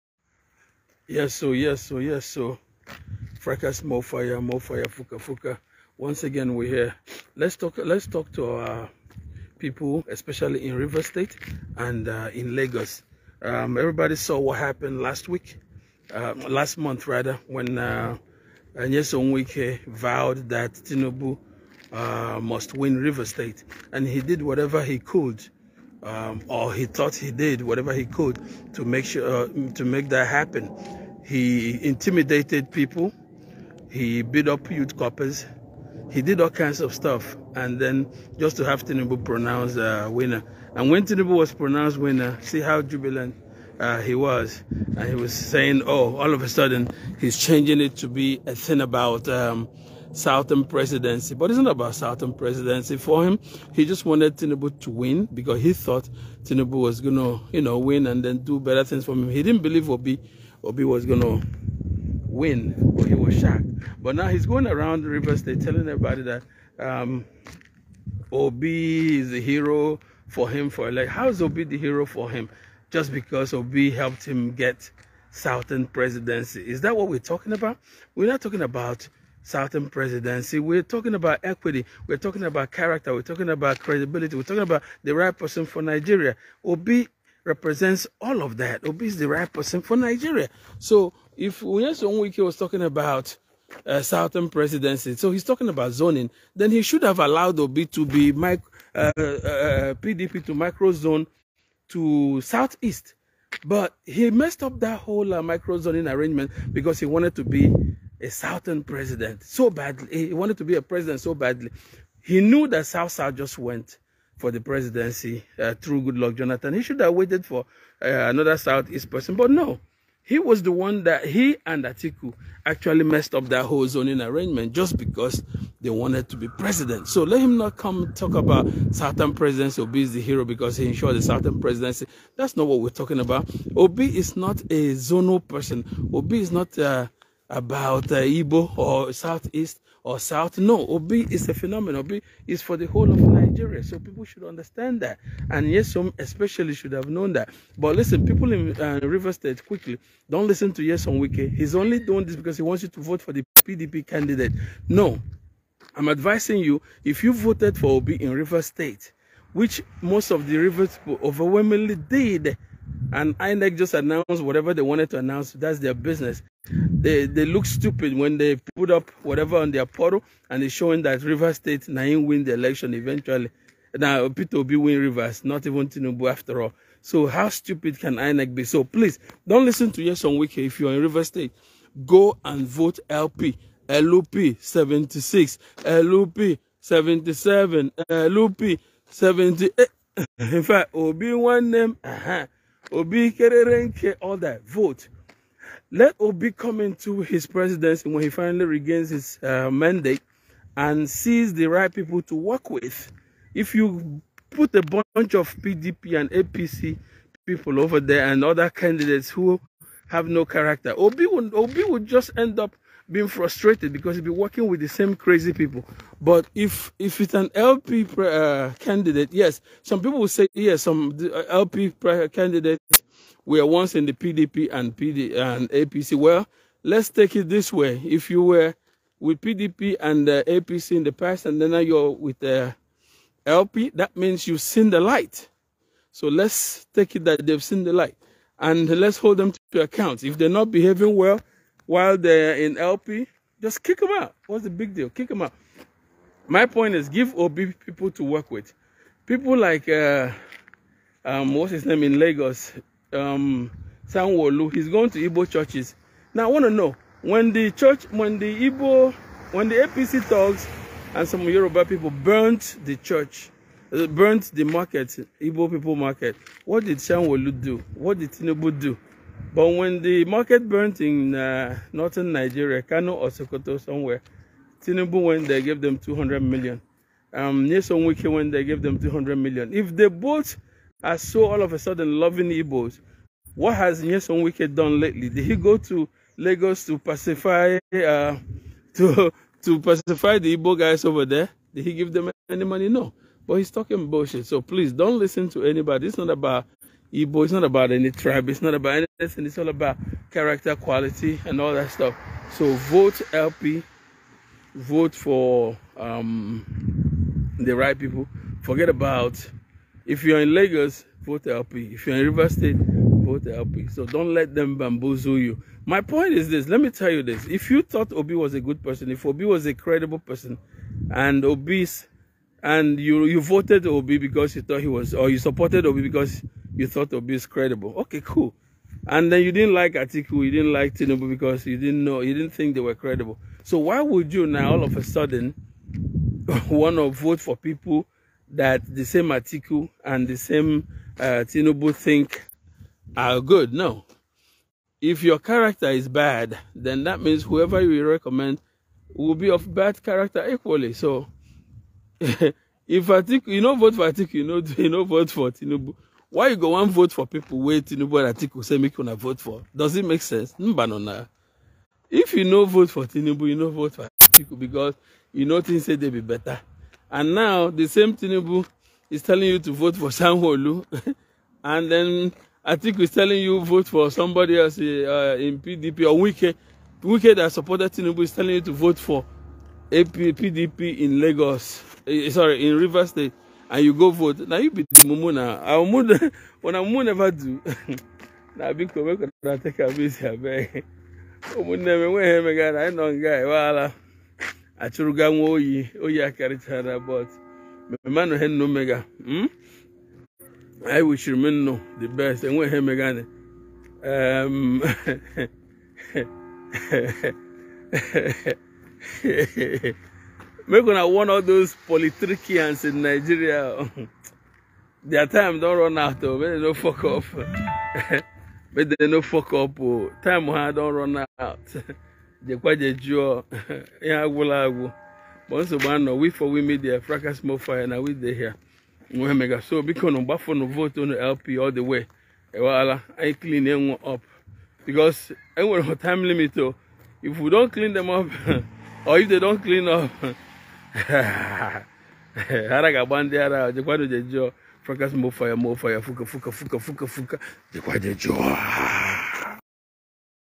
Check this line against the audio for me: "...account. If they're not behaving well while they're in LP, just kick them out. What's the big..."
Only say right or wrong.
right.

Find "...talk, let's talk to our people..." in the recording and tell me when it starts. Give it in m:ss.
0:07.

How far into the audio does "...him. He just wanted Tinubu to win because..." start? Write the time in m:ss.
0:53.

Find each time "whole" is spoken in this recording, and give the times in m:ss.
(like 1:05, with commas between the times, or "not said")
1:44, 2:03, 2:22.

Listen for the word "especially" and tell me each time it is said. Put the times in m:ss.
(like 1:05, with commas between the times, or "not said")
0:10, 2:26.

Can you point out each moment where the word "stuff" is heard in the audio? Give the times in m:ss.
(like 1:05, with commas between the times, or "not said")
0:36, 5:01.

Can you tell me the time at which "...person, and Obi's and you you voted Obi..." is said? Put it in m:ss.
5:20.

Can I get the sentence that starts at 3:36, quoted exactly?
But if if it's an LP uh, candidate, yes, some people will say yes.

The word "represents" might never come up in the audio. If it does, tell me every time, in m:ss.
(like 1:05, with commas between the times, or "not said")
1:27.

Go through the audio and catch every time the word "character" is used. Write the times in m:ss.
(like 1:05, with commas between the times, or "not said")
1:22, 3:30, 5:00, 5:45, 5:50.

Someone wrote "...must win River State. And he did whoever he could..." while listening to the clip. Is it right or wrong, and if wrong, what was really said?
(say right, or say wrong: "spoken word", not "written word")
wrong: "whatever", not "whoever".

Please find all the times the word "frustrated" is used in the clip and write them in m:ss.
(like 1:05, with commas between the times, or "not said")
3:33.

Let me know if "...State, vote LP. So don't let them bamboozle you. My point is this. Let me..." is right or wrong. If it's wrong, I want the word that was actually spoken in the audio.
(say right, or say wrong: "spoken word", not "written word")
right.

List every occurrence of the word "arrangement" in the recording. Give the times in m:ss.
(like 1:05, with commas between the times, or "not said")
1:46, 2:04.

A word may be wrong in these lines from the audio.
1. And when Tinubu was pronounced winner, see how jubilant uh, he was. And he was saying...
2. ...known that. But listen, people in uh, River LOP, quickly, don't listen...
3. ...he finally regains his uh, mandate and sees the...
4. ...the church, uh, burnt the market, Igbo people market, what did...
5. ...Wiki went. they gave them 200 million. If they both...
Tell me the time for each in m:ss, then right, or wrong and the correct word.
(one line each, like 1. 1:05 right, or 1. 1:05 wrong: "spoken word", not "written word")
1. 0:40 right
2. 2:27 wrong: "State", not "LOP"
3. 3:18 right
4. 4:22 right
5. 4:38 right.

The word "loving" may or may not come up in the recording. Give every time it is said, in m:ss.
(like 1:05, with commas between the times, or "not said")
4:42.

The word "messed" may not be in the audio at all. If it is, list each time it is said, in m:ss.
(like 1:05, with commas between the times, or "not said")
1:44, 2:03.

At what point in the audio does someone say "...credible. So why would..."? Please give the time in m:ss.
5:32.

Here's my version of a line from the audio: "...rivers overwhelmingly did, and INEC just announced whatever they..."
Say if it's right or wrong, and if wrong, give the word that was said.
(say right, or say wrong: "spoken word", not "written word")
right.